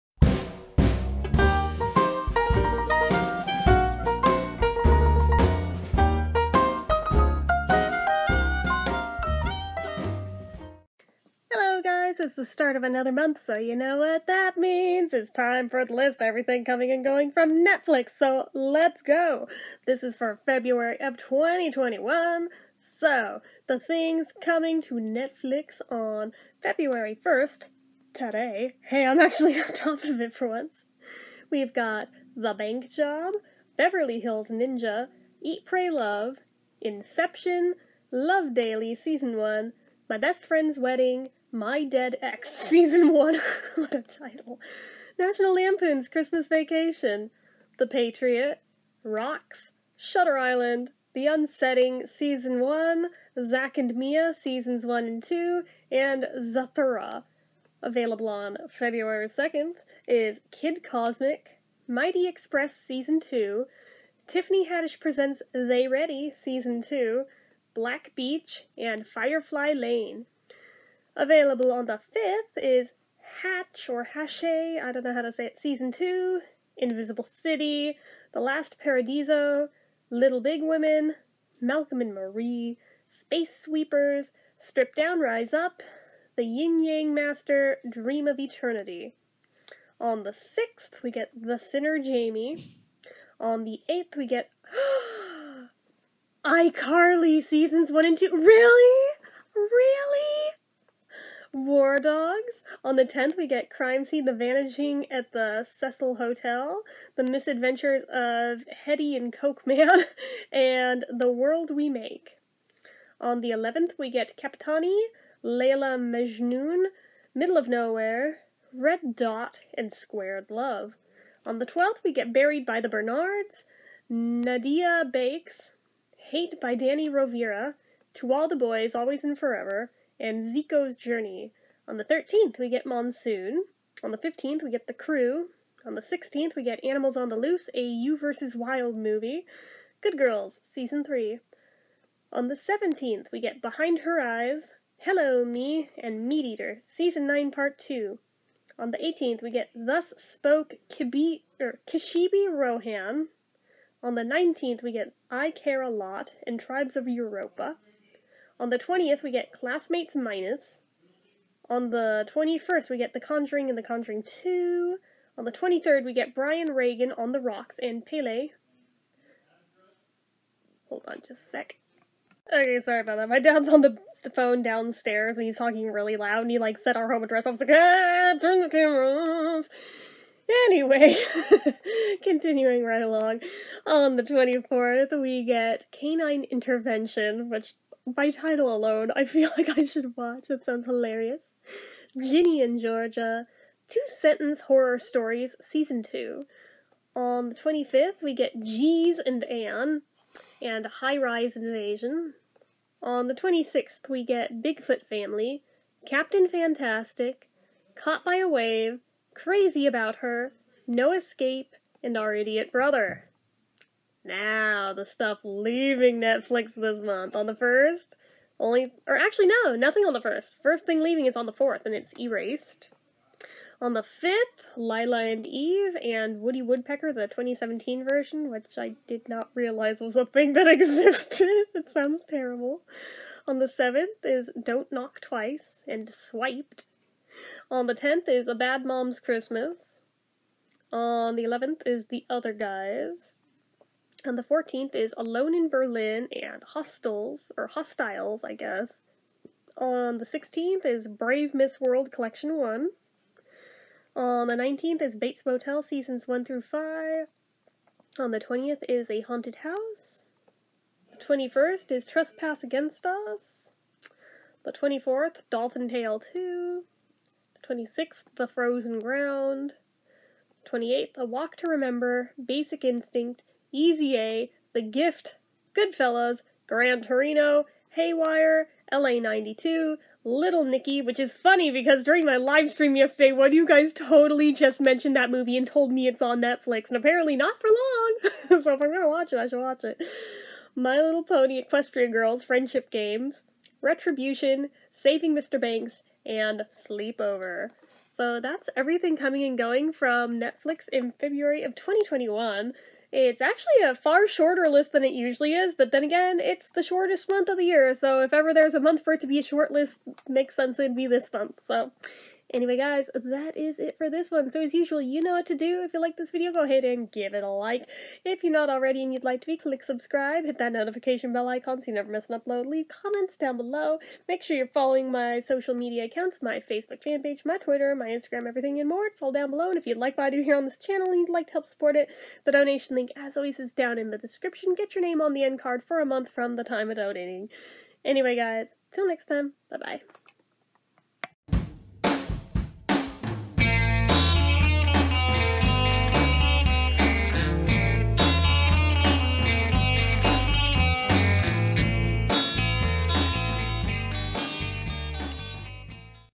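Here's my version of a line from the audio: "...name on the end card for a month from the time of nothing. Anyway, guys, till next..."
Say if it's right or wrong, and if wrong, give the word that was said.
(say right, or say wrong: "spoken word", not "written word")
wrong: "donating", not "nothing".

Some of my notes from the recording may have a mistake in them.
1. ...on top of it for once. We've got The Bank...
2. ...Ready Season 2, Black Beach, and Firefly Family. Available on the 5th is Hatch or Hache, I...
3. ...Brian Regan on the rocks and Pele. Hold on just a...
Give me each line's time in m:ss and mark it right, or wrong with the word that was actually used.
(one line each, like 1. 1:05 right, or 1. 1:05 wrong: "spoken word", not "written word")
1. 0:29 right
2. 1:05 wrong: "Lane", not "Family"
3. 2:46 right.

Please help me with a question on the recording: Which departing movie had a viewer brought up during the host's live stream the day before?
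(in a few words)
Little Nicky.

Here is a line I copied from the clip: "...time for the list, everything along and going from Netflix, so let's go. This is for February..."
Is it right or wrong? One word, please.
wrong.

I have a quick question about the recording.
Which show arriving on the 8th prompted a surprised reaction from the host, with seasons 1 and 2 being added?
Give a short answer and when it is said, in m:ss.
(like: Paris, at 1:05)
iCarly, at 1:36.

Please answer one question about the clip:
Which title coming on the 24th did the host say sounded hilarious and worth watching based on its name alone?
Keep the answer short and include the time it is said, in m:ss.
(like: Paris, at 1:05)
Canine Intervention, at 3:05.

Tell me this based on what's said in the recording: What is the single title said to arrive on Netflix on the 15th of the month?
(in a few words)
The Crew.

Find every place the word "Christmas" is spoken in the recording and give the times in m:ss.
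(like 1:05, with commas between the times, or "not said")
0:46, 3:59.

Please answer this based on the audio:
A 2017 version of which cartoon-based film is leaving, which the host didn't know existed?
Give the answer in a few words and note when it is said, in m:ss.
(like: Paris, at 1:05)
Woody Woodpecker, at 3:46.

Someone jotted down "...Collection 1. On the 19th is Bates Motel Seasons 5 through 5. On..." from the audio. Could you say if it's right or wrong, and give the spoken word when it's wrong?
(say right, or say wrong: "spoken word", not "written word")
wrong: "1", not "5".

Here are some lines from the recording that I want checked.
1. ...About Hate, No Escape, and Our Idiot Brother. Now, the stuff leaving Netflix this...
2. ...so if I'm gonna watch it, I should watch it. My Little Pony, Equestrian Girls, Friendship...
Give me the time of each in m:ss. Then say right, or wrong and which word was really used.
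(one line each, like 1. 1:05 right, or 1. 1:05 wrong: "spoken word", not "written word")
1. 3:29 wrong: "Her", not "Hate"
2. 4:48 right.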